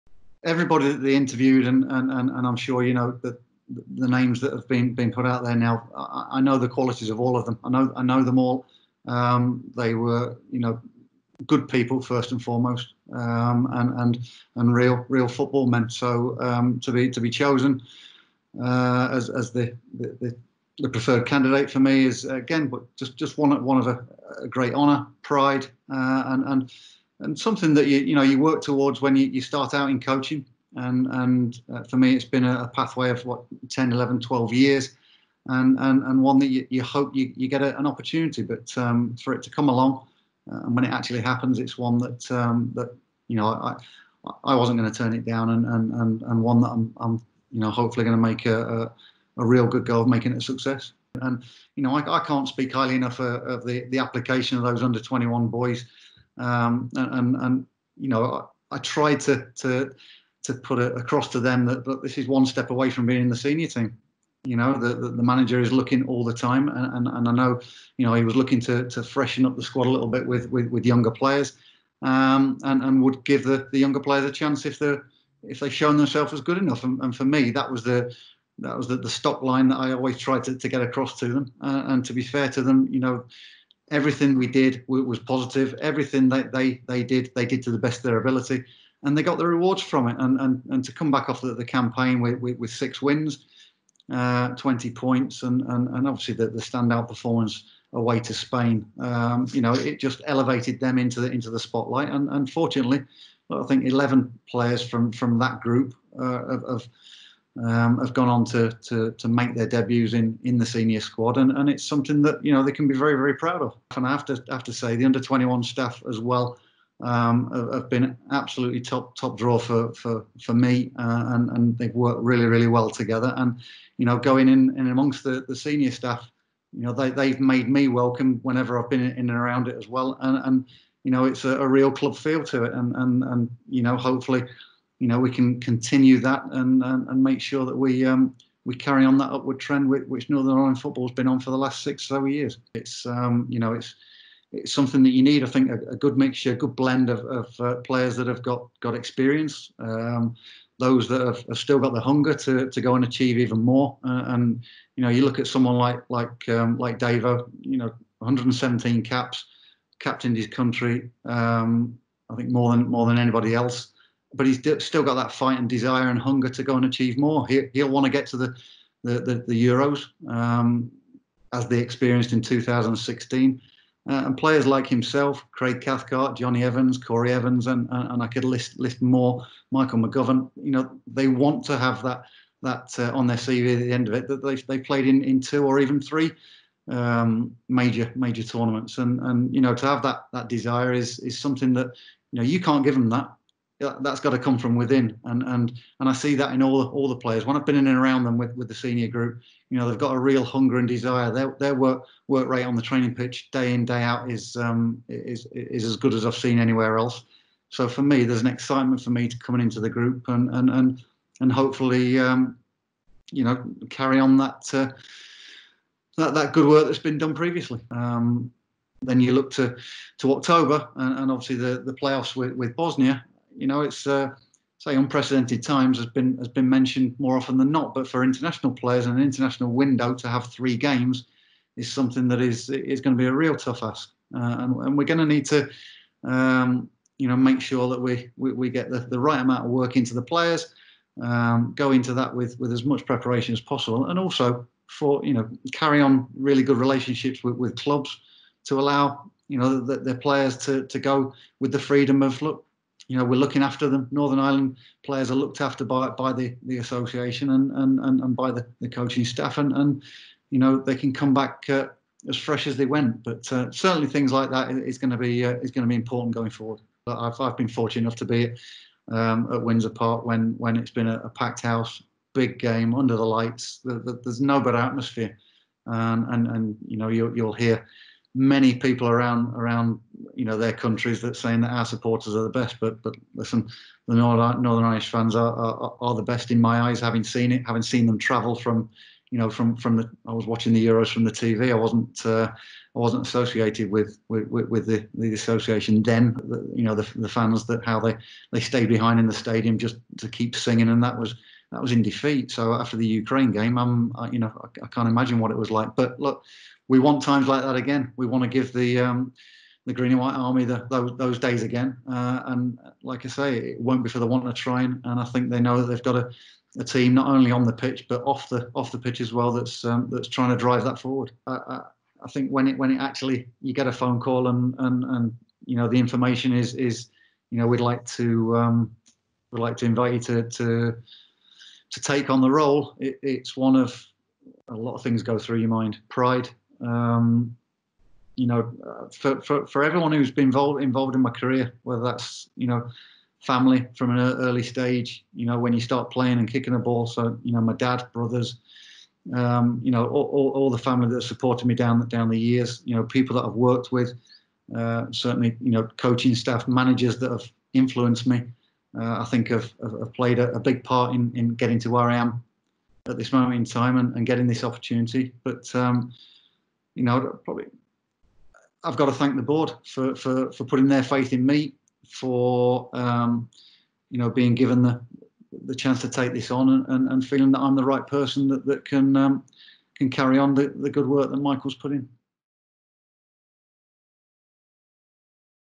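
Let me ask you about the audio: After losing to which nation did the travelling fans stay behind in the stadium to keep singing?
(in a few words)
Ukraine.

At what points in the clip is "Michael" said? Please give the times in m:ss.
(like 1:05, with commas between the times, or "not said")
2:59, 6:21.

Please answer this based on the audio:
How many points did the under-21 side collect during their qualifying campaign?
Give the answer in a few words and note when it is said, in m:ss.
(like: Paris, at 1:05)
20, at 1:34.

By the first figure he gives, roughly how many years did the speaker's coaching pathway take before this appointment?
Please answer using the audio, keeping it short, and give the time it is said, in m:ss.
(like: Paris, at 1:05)
10, at 0:33.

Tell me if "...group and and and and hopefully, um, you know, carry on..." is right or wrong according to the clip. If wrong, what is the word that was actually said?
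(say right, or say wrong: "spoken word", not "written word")
right.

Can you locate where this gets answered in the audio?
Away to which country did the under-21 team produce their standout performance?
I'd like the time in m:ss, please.
1:38.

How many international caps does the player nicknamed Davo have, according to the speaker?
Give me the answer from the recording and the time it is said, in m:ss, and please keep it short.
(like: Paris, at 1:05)
117, at 2:38.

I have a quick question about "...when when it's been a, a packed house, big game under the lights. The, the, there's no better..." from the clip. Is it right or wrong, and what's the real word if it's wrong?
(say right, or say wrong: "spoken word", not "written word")
right.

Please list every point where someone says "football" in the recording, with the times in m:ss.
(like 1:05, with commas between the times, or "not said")
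0:15, 2:20.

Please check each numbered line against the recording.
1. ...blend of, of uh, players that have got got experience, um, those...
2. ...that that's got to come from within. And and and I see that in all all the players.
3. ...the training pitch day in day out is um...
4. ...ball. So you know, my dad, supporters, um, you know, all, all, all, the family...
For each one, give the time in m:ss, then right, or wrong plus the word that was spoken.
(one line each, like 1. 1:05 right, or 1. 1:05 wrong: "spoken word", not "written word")
1. 2:26 right
2. 3:13 right
3. 3:22 right
4. 5:46 wrong: "brothers", not "supporters".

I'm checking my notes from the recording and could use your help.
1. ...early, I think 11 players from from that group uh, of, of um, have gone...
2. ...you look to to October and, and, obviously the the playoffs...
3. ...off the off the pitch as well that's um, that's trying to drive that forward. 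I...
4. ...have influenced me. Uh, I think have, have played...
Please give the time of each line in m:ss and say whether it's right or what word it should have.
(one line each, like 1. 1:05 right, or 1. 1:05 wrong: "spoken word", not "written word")
1. 1:42 wrong: "unfortunately", not "early"
2. 3:39 right
3. 5:18 right
4. 5:57 right.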